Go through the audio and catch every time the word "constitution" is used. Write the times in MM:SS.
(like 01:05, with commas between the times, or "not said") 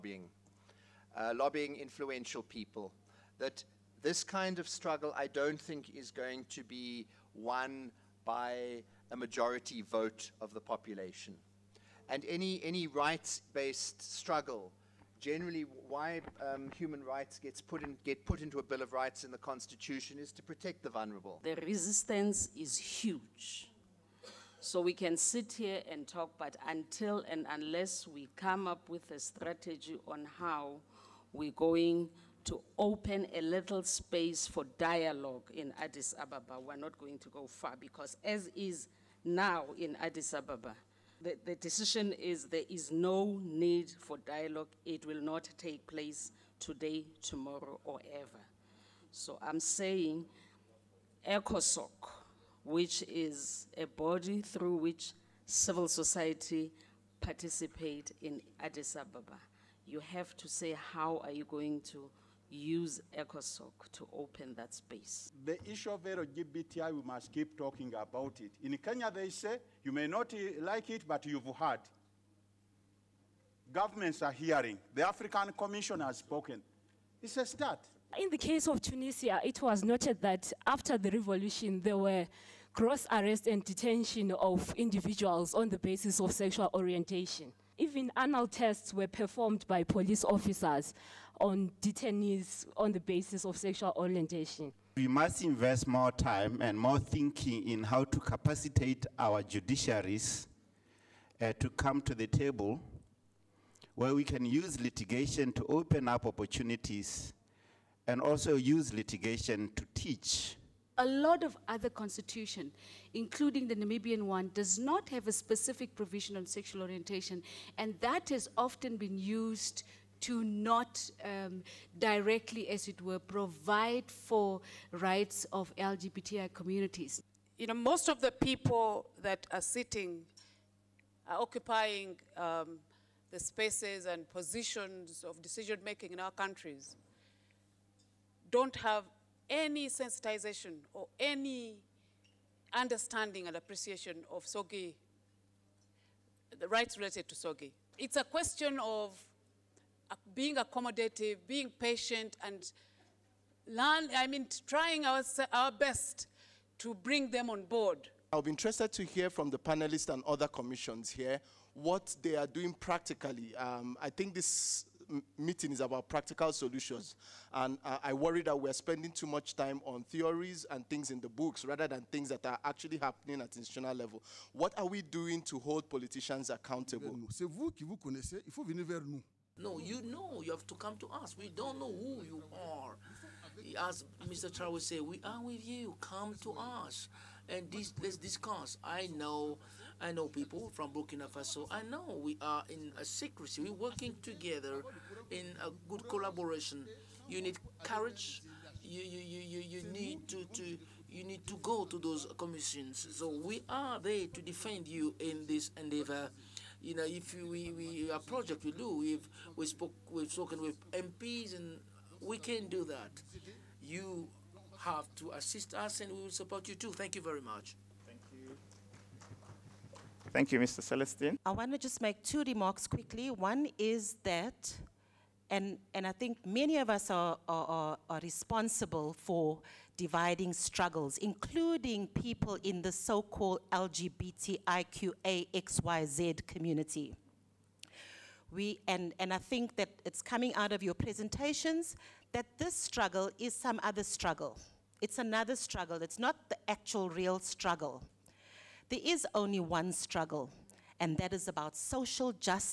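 00:19, 01:51.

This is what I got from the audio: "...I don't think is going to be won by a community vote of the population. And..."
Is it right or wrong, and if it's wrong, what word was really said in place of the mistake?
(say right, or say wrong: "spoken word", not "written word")
wrong: "majority", not "community".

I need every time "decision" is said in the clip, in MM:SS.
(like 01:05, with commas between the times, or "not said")
00:41, 02:15.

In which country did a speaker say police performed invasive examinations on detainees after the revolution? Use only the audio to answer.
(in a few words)
Tunisia.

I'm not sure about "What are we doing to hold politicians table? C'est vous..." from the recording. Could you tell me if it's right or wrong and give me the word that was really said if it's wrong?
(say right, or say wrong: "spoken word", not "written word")
wrong: "accountable", not "table".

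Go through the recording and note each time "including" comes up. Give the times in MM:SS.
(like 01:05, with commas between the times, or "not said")
01:53, 03:51.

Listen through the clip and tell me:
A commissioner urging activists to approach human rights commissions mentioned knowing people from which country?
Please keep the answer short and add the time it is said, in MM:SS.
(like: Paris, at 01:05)
Burkina Faso, at 03:10.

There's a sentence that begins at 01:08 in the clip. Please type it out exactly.
In Kenya, they say, you may not eh, like it, but you've heard.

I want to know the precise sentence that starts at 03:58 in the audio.
We, and, and I think that it's coming out of your presentations that this struggle is some other struggle.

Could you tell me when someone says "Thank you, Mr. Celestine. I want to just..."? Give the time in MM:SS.
03:40.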